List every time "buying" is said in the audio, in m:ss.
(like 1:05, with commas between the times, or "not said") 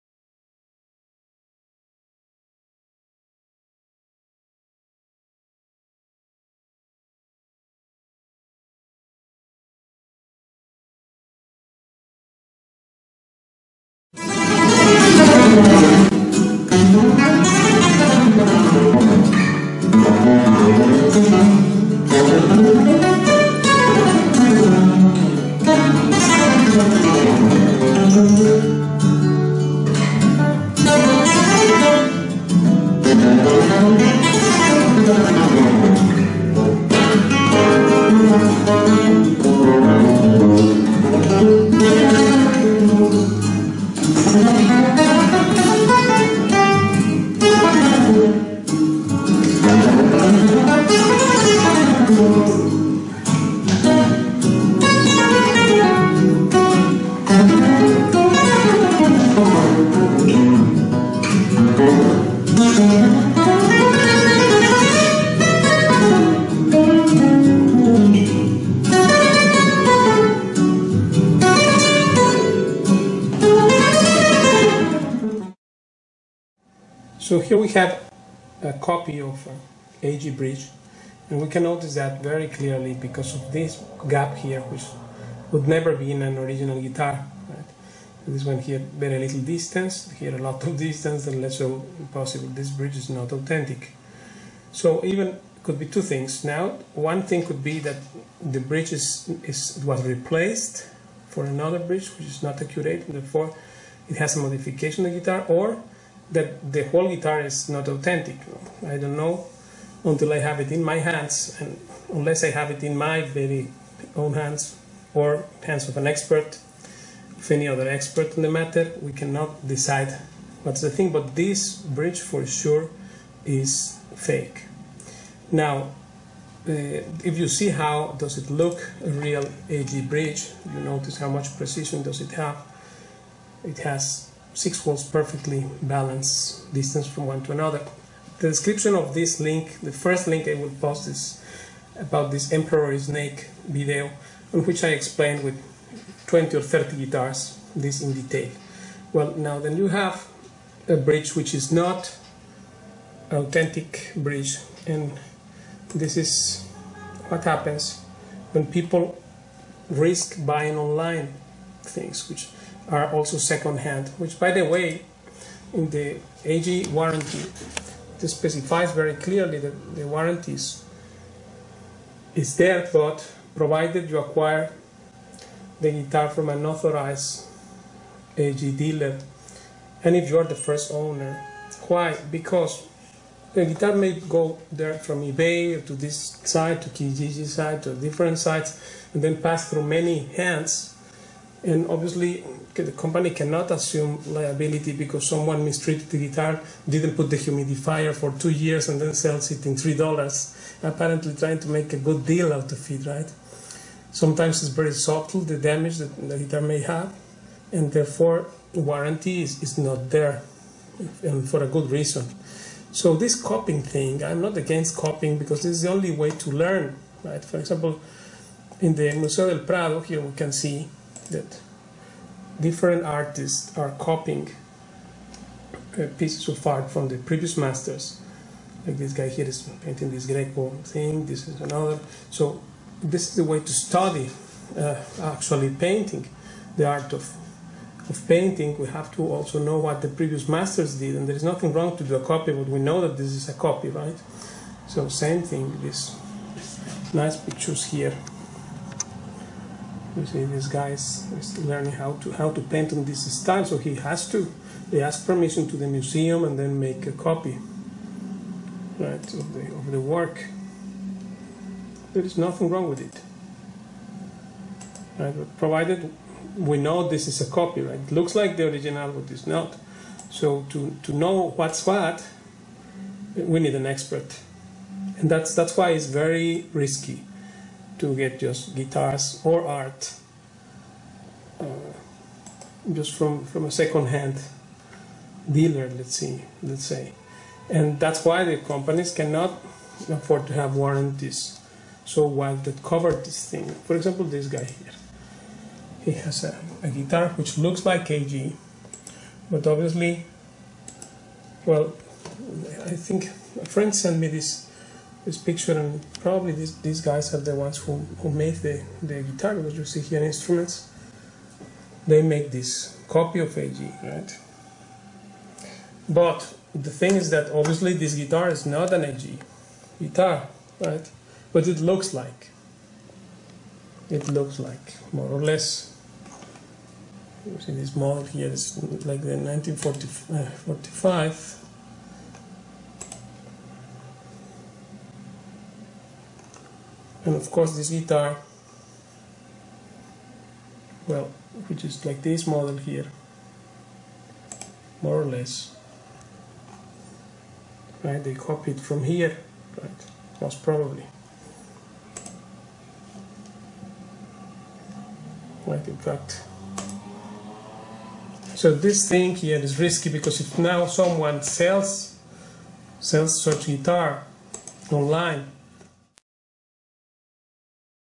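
2:40.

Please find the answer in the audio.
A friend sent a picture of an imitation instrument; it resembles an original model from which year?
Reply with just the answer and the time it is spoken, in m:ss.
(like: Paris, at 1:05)
1945, at 5:29.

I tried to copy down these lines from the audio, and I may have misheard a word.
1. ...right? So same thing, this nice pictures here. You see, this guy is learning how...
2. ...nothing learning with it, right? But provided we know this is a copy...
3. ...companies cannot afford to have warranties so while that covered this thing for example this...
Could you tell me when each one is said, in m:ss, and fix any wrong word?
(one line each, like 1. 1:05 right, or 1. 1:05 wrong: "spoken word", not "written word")
1. 4:03 right
2. 4:22 wrong: "wrong", not "learning"
3. 4:48 right.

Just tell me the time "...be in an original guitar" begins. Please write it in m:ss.
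1:25.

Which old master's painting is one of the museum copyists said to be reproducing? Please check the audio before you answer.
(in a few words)
Greco.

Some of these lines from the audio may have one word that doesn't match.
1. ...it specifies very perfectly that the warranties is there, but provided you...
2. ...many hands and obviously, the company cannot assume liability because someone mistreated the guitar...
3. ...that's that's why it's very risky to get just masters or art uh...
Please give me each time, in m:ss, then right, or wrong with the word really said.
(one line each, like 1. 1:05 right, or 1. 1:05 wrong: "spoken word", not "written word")
1. 2:48 wrong: "clearly", not "perfectly"
2. 3:09 right
3. 4:35 wrong: "guitars", not "masters".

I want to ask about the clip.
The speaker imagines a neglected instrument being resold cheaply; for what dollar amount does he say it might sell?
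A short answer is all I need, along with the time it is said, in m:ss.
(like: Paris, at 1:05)
3 dollars, at 3:19.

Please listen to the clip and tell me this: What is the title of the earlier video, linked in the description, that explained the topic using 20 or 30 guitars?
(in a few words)
emperor snake.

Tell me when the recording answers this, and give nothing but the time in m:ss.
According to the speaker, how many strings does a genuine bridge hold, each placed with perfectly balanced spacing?
2:14.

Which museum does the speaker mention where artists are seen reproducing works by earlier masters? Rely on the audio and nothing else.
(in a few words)
Museo del Prado.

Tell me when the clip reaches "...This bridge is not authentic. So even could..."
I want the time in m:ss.
1:32.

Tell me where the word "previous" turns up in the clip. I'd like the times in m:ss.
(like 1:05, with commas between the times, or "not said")
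3:47, 4:00.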